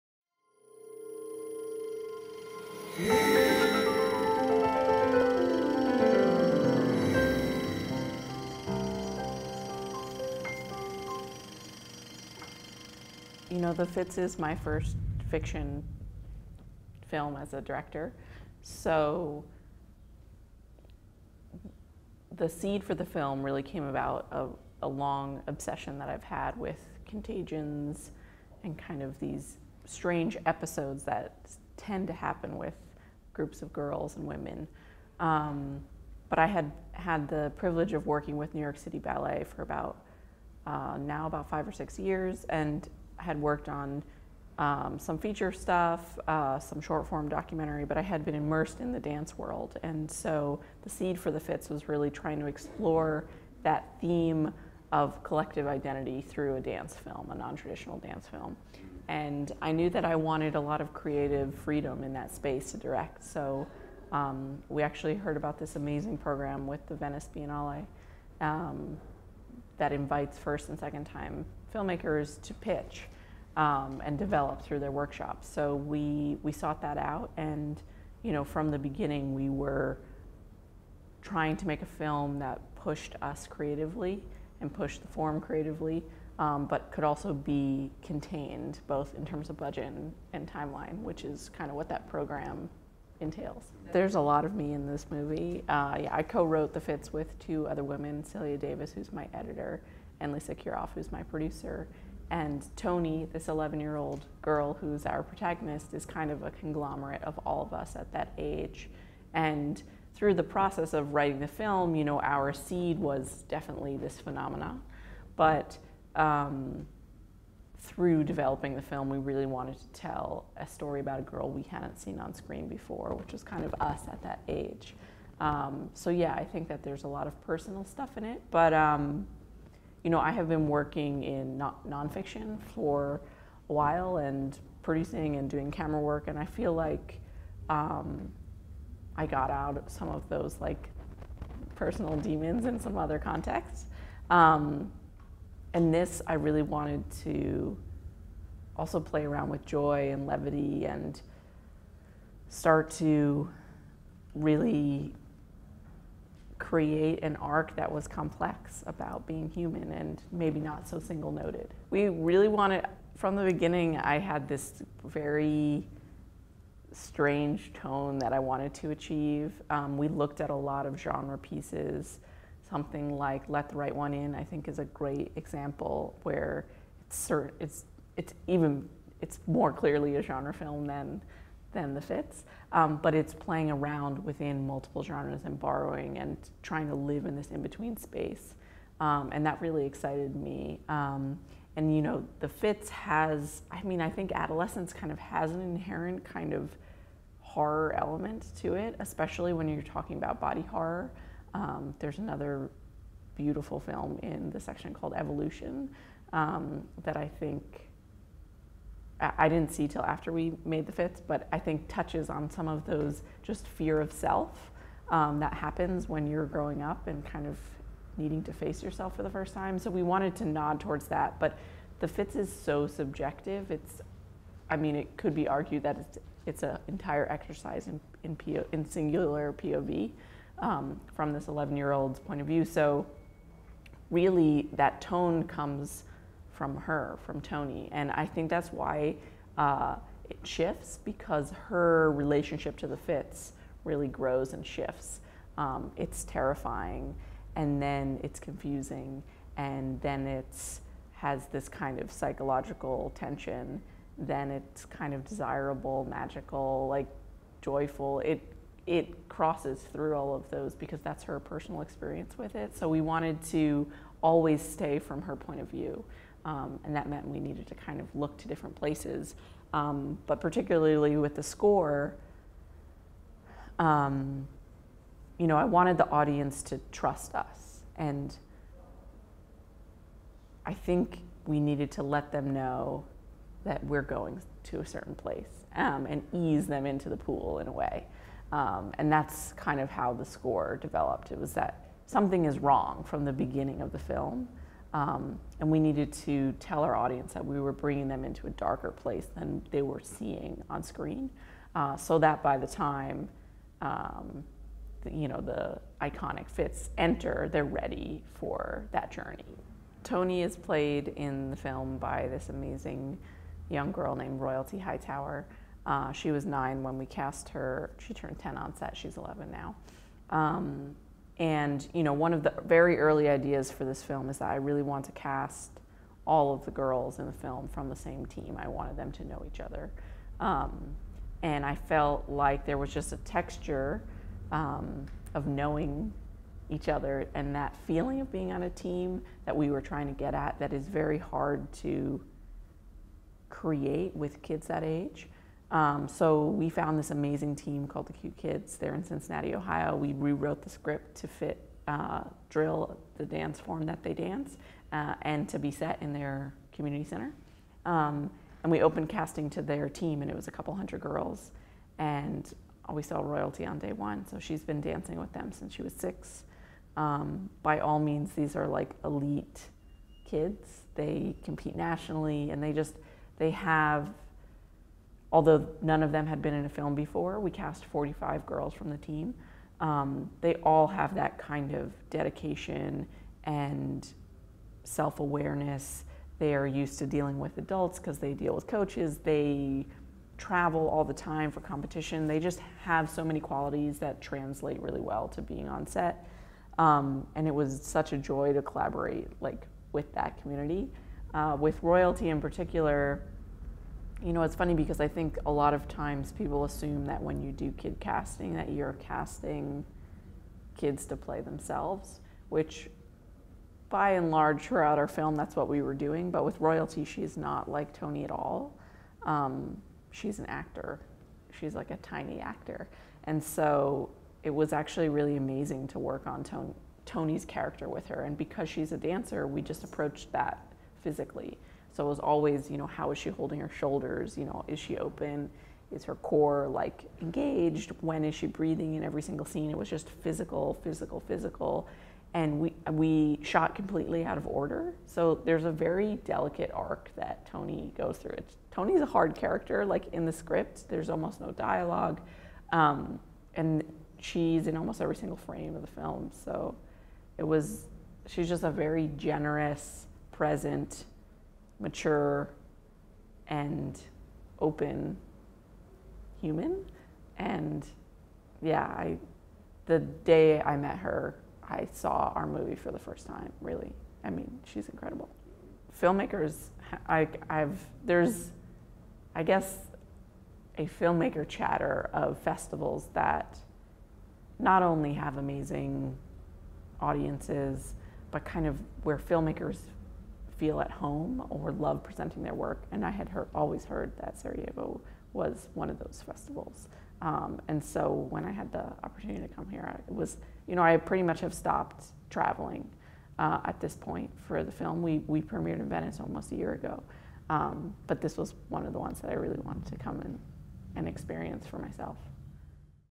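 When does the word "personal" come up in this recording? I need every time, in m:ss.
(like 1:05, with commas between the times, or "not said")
2:07, 2:21, 4:21.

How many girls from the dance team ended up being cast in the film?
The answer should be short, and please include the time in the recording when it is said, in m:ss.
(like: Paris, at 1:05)
45, at 6:17.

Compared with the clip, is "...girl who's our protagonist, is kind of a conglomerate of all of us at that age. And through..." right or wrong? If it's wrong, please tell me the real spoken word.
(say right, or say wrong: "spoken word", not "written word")
right.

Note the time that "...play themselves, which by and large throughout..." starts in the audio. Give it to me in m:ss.
6:51.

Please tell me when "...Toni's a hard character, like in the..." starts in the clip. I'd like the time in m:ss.
7:28.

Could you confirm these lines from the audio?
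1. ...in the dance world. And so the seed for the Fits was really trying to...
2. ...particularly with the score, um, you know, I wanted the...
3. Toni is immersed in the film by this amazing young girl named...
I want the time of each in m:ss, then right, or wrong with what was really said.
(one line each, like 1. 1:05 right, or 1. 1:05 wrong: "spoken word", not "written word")
1. 0:48 right
2. 4:30 right
3. 5:10 wrong: "played", not "immersed".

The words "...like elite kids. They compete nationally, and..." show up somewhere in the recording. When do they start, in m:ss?
6:08.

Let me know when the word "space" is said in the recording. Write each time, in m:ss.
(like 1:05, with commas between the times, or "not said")
1:02, 3:07.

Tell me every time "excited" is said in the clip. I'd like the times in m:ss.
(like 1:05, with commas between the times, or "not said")
3:09.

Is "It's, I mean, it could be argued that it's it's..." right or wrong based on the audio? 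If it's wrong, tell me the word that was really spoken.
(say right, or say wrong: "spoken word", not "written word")
right.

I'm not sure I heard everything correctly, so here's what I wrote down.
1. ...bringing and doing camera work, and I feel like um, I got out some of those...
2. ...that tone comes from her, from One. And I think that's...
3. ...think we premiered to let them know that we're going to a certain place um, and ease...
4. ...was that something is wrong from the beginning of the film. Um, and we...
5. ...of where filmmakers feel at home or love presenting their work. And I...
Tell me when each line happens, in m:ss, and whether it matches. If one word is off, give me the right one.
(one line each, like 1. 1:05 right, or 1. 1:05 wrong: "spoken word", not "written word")
1. 2:14 wrong: "producing", not "bringing"
2. 3:54 wrong: "Toni", not "One"
3. 4:40 wrong: "needed", not "premiered"
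4. 4:51 right
5. 8:08 right.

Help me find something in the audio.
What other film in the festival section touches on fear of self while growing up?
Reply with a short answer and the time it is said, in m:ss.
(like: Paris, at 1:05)
Evolution, at 3:25.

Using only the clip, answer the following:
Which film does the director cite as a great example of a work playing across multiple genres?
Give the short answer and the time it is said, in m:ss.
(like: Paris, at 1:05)
Let the Right One In, at 2:53.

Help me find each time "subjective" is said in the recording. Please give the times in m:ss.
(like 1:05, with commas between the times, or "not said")
3:42.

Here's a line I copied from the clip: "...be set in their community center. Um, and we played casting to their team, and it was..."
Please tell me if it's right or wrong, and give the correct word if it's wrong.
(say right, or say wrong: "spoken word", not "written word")
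wrong: "opened", not "played".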